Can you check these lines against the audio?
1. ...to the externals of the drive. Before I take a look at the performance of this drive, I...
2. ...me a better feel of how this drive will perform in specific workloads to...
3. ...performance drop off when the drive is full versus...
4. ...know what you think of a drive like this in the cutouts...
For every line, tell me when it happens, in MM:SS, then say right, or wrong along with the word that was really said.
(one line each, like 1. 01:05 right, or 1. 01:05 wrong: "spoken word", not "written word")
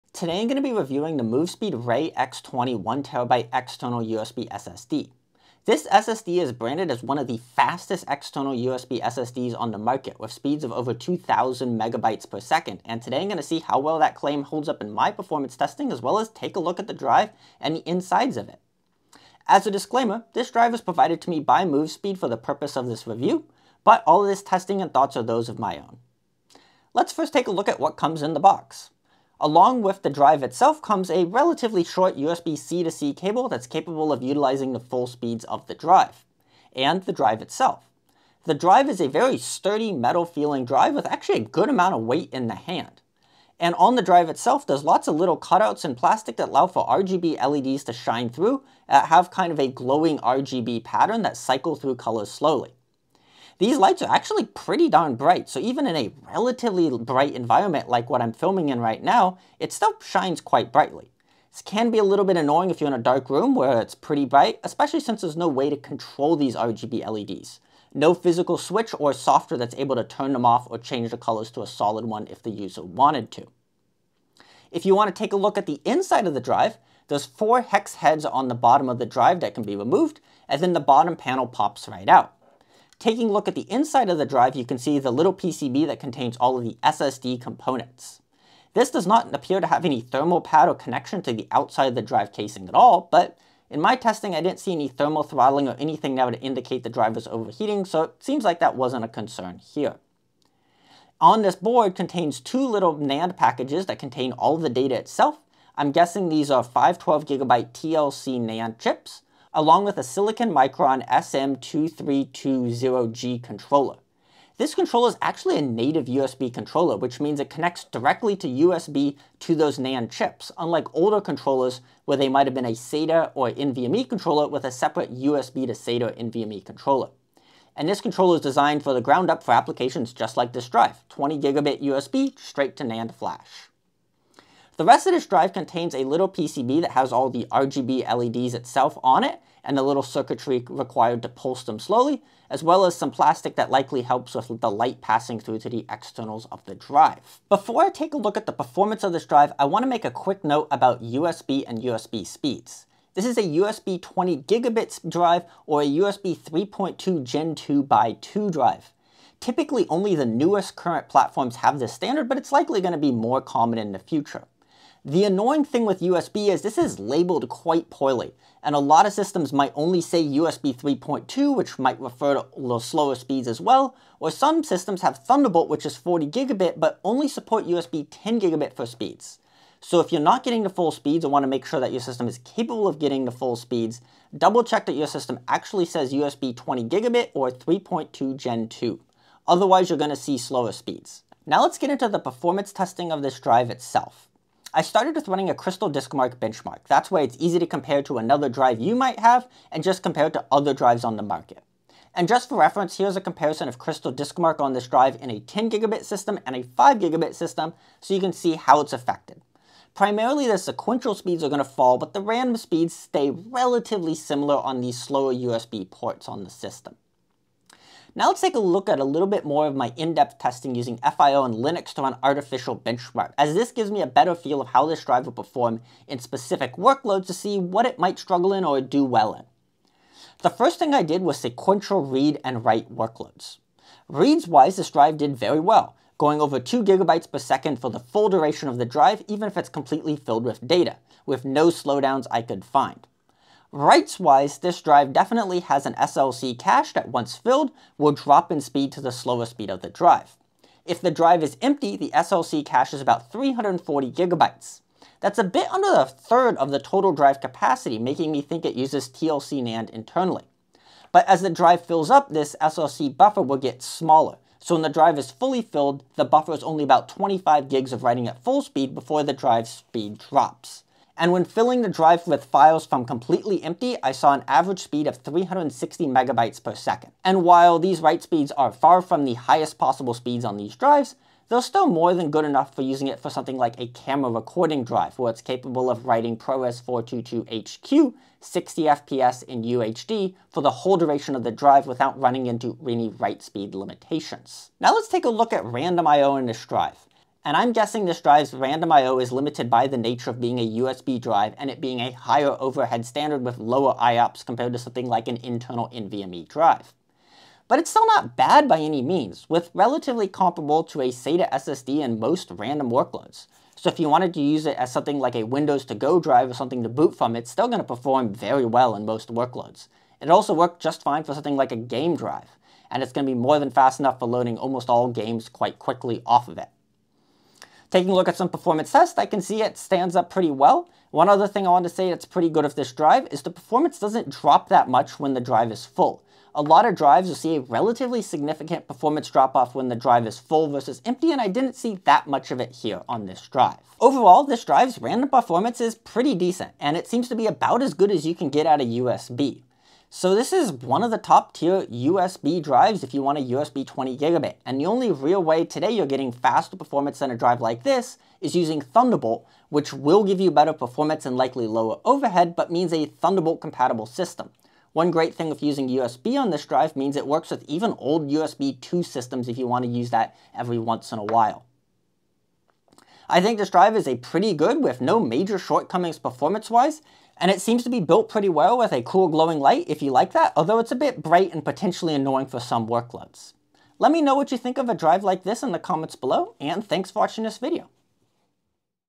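1. 02:25 right
2. 03:43 right
3. 05:38 right
4. 06:24 wrong: "comments", not "cutouts".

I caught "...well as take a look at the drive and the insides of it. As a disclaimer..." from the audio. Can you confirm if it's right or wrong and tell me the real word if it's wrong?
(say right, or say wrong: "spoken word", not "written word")
right.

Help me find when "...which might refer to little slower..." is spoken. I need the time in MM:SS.
02:51.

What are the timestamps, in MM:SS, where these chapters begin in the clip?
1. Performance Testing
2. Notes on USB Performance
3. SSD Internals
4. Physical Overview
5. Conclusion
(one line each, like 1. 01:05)
1. 03:11
2. 02:27
3. 01:14
4. 00:26
5. 05:43.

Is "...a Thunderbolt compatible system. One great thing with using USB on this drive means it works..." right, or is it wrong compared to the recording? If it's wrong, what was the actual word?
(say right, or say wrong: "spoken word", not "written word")
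right.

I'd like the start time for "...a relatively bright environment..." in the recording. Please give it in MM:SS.
00:55.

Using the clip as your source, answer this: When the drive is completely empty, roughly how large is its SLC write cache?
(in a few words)
340 GB.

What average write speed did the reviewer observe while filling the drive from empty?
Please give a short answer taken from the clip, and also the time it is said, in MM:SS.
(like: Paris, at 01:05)
360 MB/s, at 04:35.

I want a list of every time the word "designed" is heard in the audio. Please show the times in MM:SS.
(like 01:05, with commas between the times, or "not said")
02:08.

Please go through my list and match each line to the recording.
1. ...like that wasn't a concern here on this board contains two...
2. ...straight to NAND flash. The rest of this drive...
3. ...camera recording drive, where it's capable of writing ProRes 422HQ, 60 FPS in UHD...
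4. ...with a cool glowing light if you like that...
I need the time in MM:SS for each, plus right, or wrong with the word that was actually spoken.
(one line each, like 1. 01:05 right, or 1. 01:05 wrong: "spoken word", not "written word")
1. 01:38 right
2. 02:12 right
3. 04:43 right
4. 06:18 right.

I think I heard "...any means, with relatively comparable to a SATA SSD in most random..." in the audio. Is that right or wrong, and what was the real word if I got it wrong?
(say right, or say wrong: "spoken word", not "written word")
right.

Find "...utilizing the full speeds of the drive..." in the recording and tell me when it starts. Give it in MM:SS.
00:34.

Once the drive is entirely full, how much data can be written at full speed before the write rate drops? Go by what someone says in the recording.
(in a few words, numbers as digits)
25 GB.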